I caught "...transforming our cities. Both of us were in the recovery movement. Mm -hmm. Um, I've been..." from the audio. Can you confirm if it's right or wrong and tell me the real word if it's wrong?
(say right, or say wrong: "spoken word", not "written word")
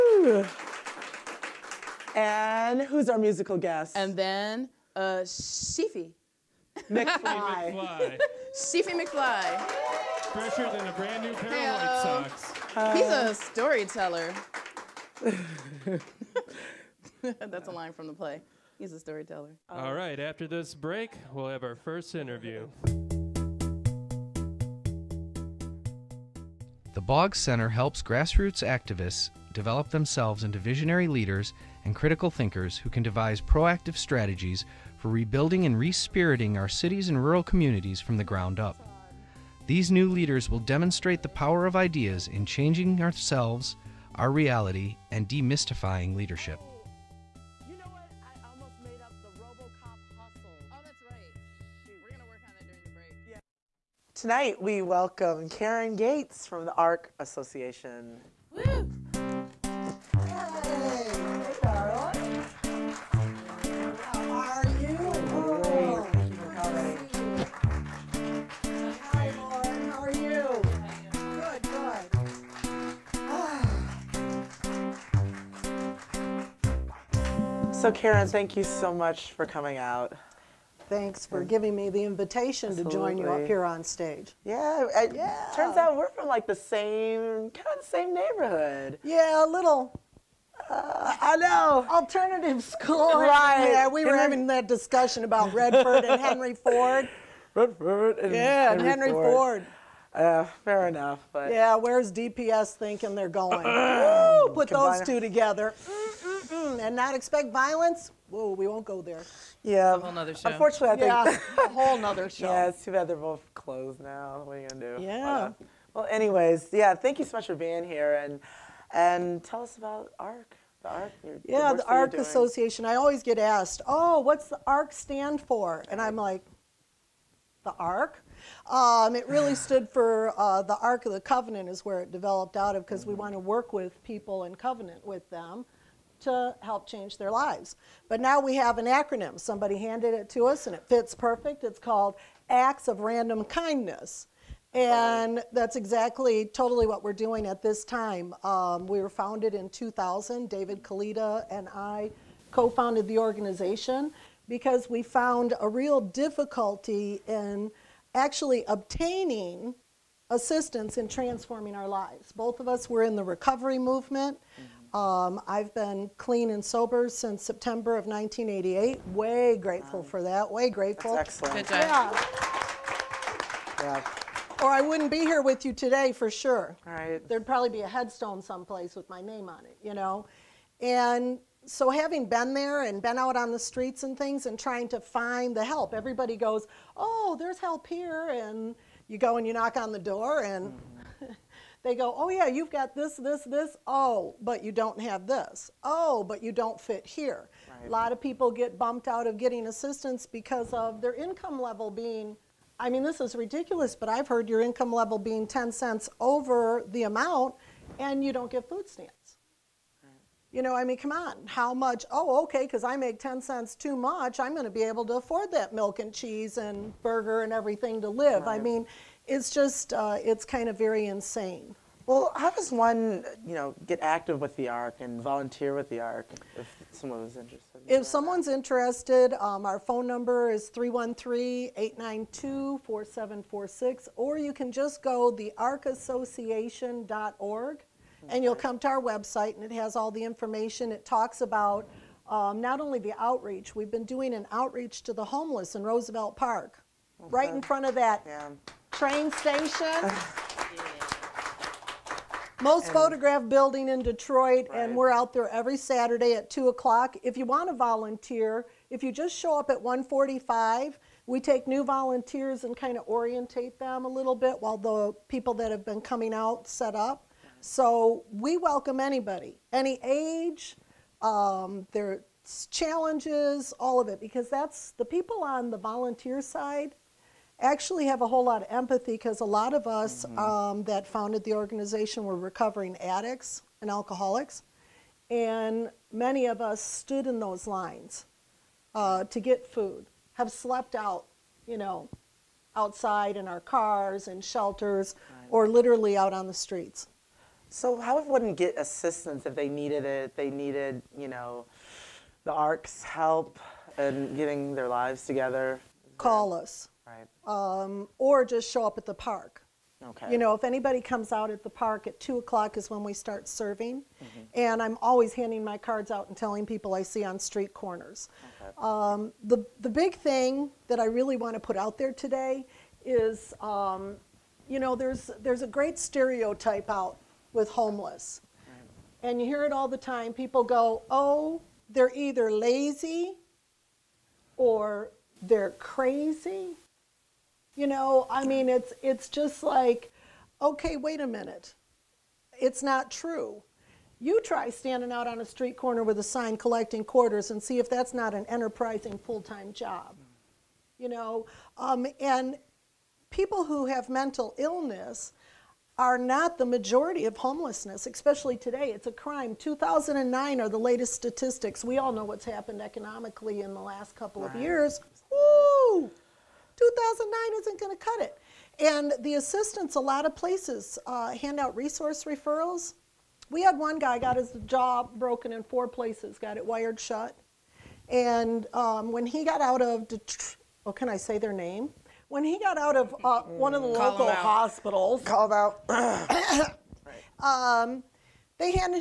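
wrong: "lives", not "cities".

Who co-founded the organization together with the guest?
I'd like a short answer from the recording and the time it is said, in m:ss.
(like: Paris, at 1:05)
David Kalita, at 2:30.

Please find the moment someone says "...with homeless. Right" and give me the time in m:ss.
5:27.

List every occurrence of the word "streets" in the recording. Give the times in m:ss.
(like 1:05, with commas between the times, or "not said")
3:03, 4:56, 5:17, 5:45.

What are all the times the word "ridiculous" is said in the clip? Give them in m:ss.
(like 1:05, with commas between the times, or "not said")
3:23.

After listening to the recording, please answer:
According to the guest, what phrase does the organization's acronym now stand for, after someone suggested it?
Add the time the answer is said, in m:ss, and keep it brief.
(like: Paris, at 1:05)
Acts of Random Kindness, at 2:22.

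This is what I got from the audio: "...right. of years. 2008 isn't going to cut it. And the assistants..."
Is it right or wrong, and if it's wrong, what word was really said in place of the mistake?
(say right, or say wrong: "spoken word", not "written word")
wrong: "2009", not "2008".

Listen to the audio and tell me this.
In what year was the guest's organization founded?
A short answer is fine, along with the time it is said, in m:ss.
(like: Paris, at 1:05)
2000, at 2:29.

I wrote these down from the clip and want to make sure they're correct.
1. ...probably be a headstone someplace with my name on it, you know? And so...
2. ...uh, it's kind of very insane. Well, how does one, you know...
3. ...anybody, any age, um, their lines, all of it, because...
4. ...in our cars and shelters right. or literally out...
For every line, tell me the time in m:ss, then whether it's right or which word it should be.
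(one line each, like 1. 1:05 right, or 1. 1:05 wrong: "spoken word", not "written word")
1. 2:57 right
2. 3:39 right
3. 4:28 wrong: "challenges", not "lines"
4. 4:53 right.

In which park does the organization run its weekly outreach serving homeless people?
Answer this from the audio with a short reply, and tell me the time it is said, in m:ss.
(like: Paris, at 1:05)
Roosevelt Park, at 4:05.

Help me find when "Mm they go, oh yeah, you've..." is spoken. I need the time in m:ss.
3:10.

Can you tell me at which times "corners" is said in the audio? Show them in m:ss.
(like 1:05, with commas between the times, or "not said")
5:17, 5:45.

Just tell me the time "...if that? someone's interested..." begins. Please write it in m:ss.
3:47.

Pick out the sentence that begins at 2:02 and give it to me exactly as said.
I always get asked, oh, what's the ARC stand for?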